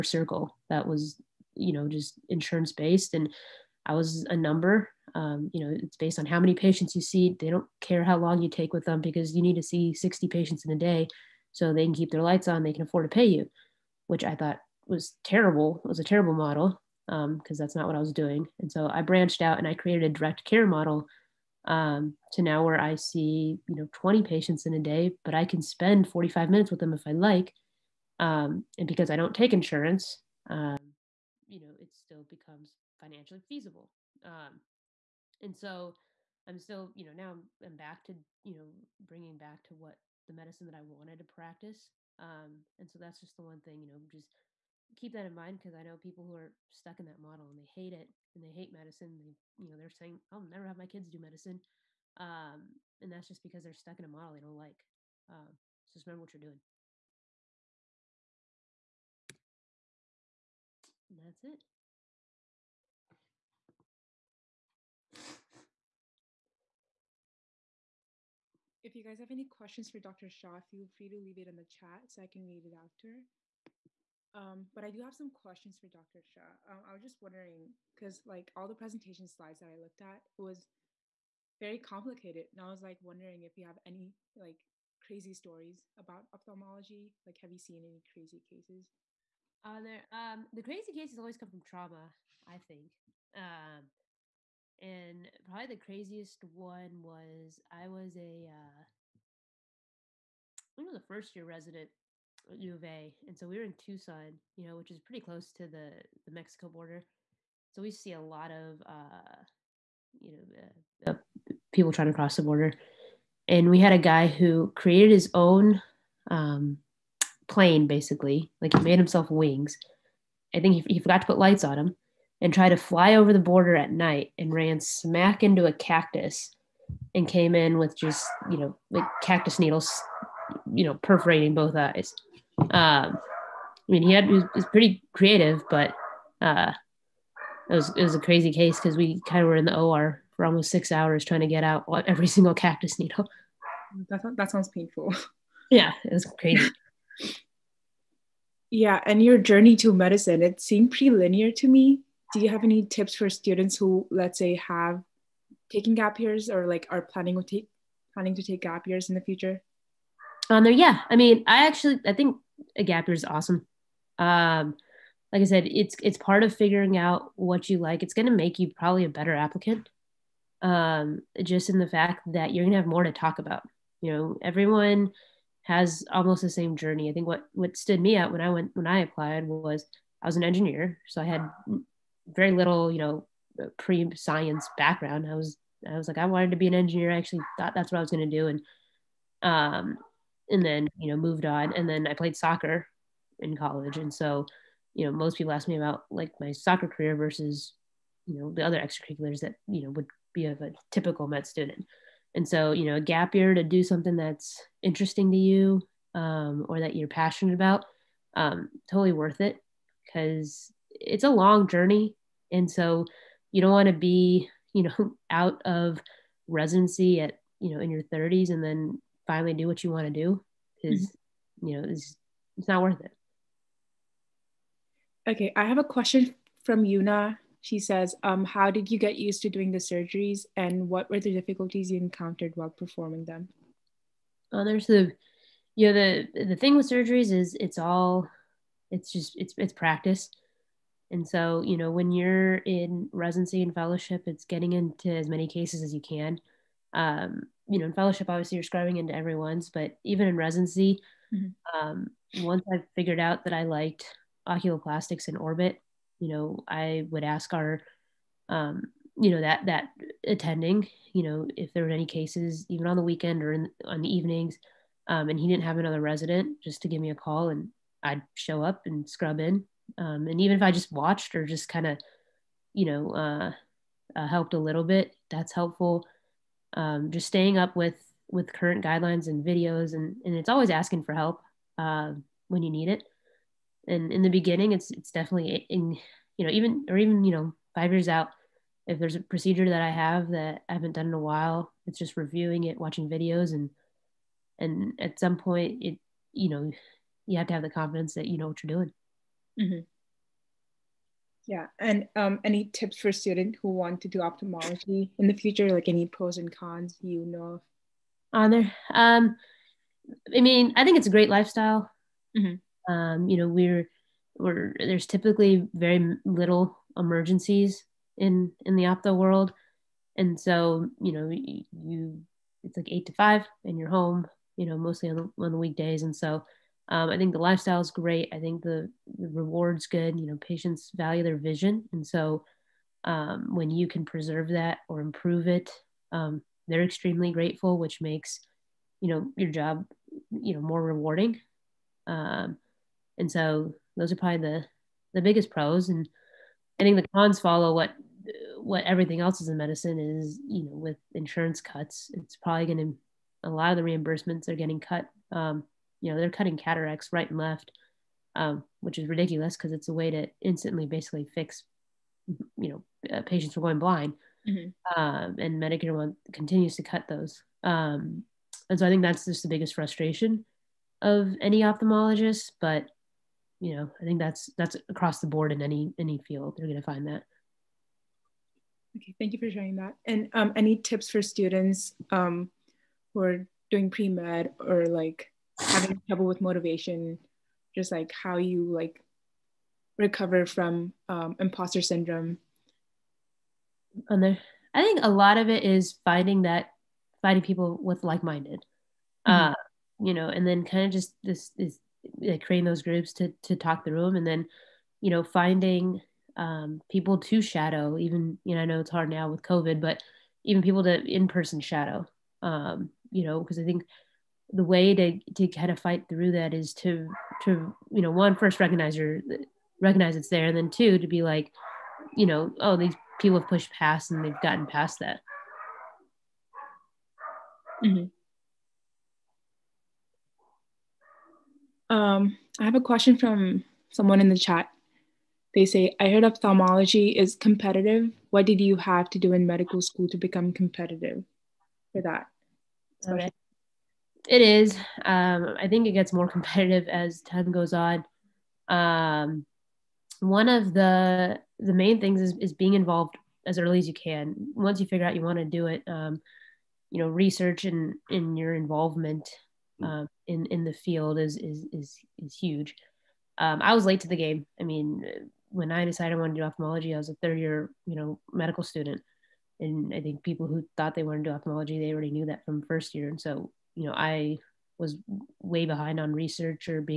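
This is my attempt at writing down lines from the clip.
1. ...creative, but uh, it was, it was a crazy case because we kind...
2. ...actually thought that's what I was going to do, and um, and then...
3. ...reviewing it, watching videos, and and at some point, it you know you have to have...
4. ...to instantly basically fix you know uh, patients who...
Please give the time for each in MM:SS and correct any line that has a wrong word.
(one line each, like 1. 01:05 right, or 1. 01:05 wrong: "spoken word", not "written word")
1. 02:15 right
2. 03:07 right
3. 04:52 right
4. 06:00 right.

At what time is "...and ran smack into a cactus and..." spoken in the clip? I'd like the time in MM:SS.
02:04.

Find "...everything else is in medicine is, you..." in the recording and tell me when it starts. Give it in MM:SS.
05:48.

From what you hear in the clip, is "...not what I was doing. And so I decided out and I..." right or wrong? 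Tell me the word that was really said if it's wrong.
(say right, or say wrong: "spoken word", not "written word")
wrong: "branched", not "decided".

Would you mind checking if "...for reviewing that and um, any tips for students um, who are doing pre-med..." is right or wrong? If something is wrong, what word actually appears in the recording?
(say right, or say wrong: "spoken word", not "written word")
wrong: "sharing", not "reviewing".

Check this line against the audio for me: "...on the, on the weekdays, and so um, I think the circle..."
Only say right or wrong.
wrong.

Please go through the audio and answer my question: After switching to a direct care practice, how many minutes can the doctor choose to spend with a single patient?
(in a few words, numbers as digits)
45 minutes.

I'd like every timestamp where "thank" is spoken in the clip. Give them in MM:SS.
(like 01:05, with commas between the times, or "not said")
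06:19.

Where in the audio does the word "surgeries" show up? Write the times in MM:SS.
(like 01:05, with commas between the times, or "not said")
03:49, 03:56.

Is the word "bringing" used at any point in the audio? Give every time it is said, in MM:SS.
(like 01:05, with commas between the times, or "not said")
00:39.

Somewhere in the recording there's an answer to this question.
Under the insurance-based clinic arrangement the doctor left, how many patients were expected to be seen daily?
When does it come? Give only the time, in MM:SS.
00:09.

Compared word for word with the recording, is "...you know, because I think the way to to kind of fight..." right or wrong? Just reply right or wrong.
right.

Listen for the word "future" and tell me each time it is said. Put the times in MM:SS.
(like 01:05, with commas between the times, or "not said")
02:39, 05:05.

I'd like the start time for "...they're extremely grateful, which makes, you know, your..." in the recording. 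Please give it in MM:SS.
05:36.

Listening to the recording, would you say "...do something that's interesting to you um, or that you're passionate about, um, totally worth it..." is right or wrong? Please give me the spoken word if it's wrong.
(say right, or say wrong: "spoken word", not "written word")
right.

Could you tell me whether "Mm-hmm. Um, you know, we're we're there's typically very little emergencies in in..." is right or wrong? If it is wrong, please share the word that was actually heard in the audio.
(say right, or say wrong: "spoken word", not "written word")
right.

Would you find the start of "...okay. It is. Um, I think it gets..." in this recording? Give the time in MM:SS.
07:23.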